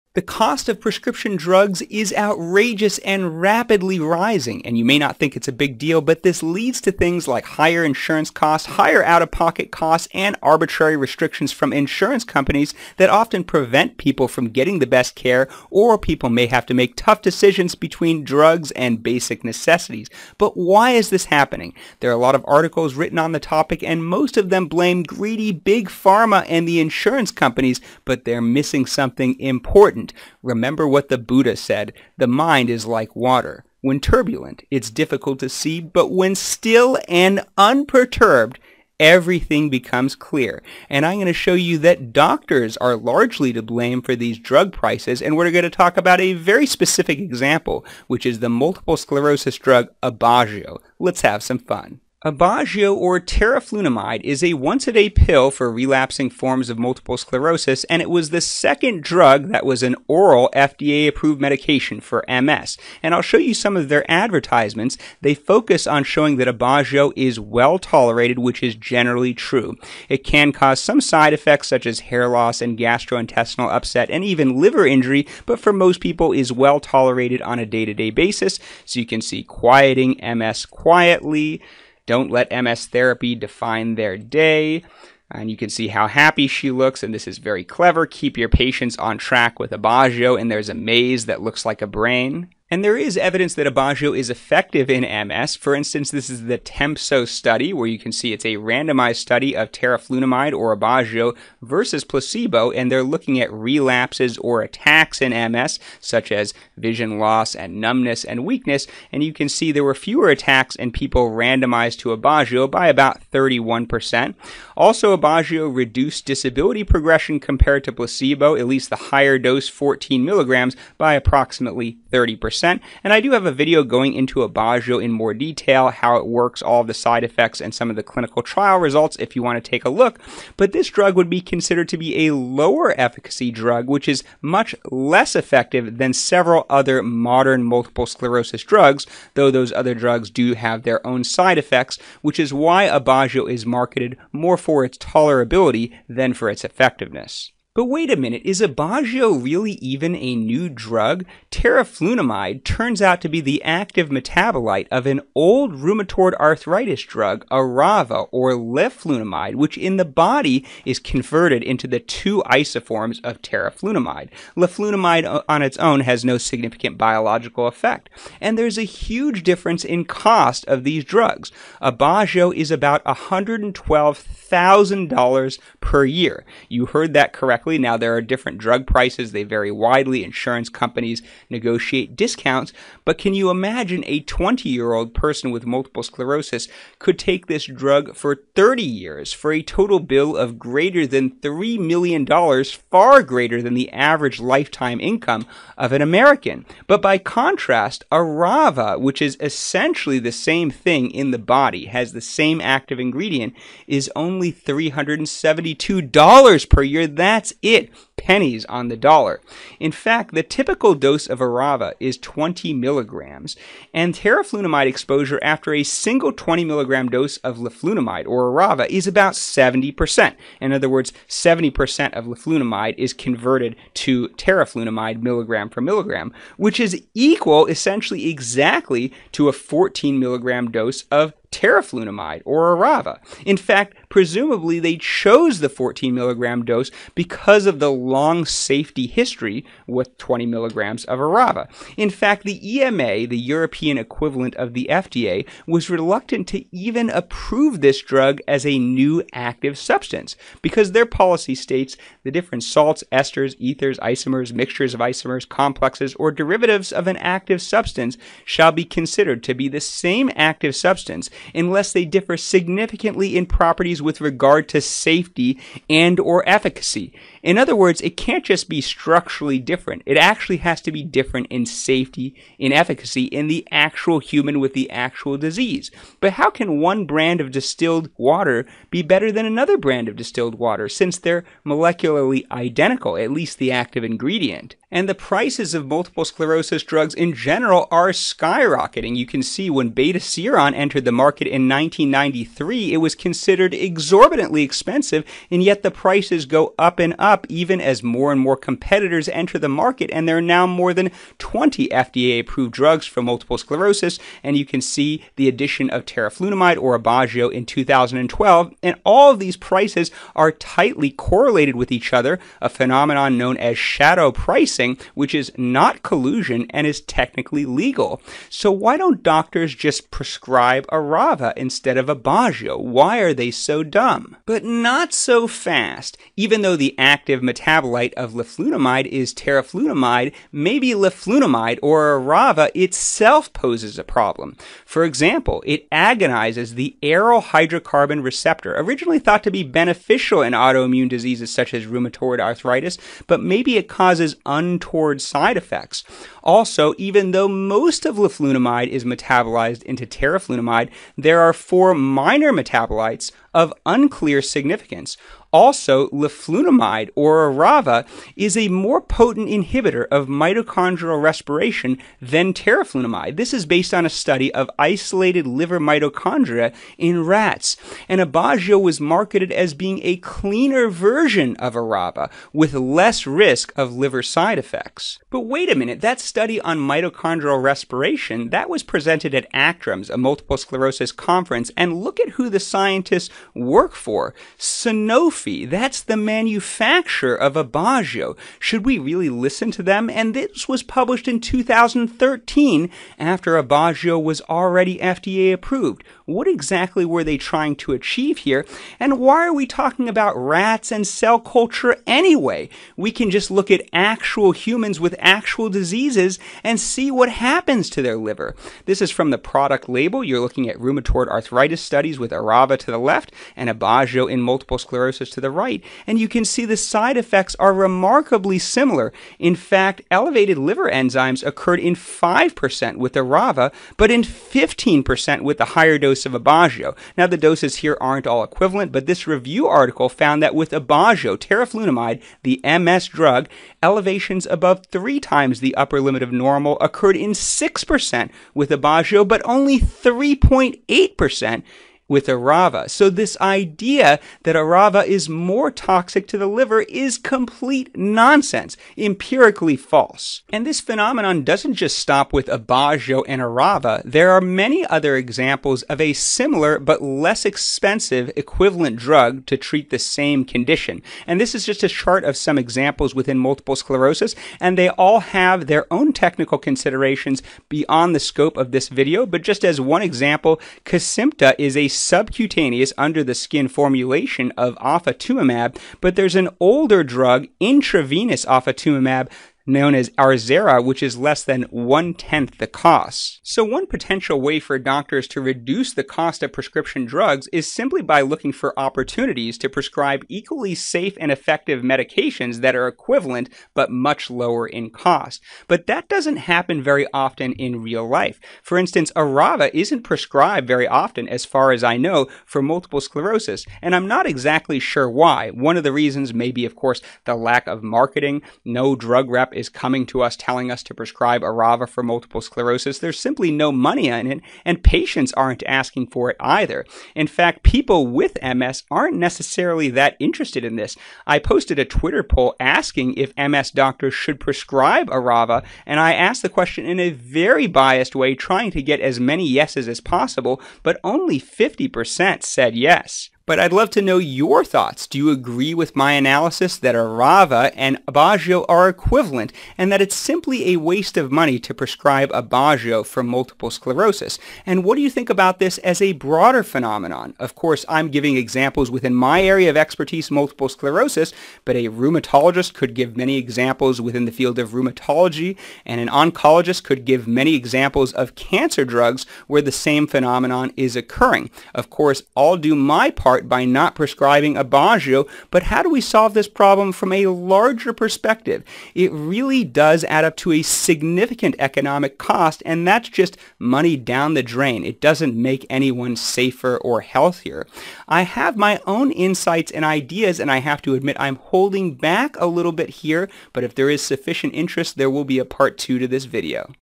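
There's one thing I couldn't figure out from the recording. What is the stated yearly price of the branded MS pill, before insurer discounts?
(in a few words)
$112,000.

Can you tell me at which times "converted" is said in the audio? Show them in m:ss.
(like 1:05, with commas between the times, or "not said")
2:40, 3:43.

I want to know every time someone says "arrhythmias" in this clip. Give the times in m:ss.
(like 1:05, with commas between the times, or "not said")
not said.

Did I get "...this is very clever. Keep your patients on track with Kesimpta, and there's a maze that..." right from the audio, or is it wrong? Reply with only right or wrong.
wrong.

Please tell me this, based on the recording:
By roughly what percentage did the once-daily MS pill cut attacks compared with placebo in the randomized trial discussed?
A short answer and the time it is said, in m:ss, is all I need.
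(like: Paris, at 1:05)
31%, at 1:53.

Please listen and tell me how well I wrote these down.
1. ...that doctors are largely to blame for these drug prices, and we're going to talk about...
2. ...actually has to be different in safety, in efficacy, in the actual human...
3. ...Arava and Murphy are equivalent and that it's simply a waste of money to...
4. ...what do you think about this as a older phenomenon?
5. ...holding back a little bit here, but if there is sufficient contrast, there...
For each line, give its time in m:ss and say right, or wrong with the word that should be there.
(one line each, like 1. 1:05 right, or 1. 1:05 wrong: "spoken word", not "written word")
1. 0:41 right
2. 4:30 right
3. 8:56 wrong: "Aubagio", not "Murphy"
4. 9:04 wrong: "broader", not "older"
5. 9:41 wrong: "interest", not "contrast".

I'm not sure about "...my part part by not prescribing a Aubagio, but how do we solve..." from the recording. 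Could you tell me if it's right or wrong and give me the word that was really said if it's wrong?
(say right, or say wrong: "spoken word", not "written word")
right.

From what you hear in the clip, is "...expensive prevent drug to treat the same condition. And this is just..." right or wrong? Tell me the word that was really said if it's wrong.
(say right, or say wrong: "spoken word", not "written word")
wrong: "equivalent", not "prevent".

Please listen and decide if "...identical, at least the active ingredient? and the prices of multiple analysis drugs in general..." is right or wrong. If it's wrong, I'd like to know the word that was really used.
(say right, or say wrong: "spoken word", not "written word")
wrong: "sclerosis", not "analysis".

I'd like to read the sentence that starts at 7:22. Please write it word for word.
So this idea that Arava is more toxic to the liver is complete nonsense, empirically false.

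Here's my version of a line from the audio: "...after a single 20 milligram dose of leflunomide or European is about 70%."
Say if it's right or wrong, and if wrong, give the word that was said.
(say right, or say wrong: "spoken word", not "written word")
wrong: "Arava", not "European".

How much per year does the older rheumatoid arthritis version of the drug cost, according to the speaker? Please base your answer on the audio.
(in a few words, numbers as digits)
$372.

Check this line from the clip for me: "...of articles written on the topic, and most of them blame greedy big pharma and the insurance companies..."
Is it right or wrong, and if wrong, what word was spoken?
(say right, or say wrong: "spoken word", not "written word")
right.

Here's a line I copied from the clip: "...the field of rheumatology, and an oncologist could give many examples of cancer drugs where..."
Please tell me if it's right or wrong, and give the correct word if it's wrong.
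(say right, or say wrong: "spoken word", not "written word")
right.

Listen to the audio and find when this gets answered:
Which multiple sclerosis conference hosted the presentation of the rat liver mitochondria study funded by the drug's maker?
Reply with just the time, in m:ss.
6:19.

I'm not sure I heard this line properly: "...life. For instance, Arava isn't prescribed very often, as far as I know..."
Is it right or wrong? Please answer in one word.
right.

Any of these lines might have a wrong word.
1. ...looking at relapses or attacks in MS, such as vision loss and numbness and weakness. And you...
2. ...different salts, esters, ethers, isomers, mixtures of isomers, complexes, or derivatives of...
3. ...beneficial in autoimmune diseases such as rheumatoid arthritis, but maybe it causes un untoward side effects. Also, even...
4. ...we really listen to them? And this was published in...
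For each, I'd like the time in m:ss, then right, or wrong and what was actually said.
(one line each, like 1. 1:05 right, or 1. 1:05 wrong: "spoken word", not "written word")
1. 1:43 right
2. 4:12 right
3. 5:39 right
4. 6:28 right.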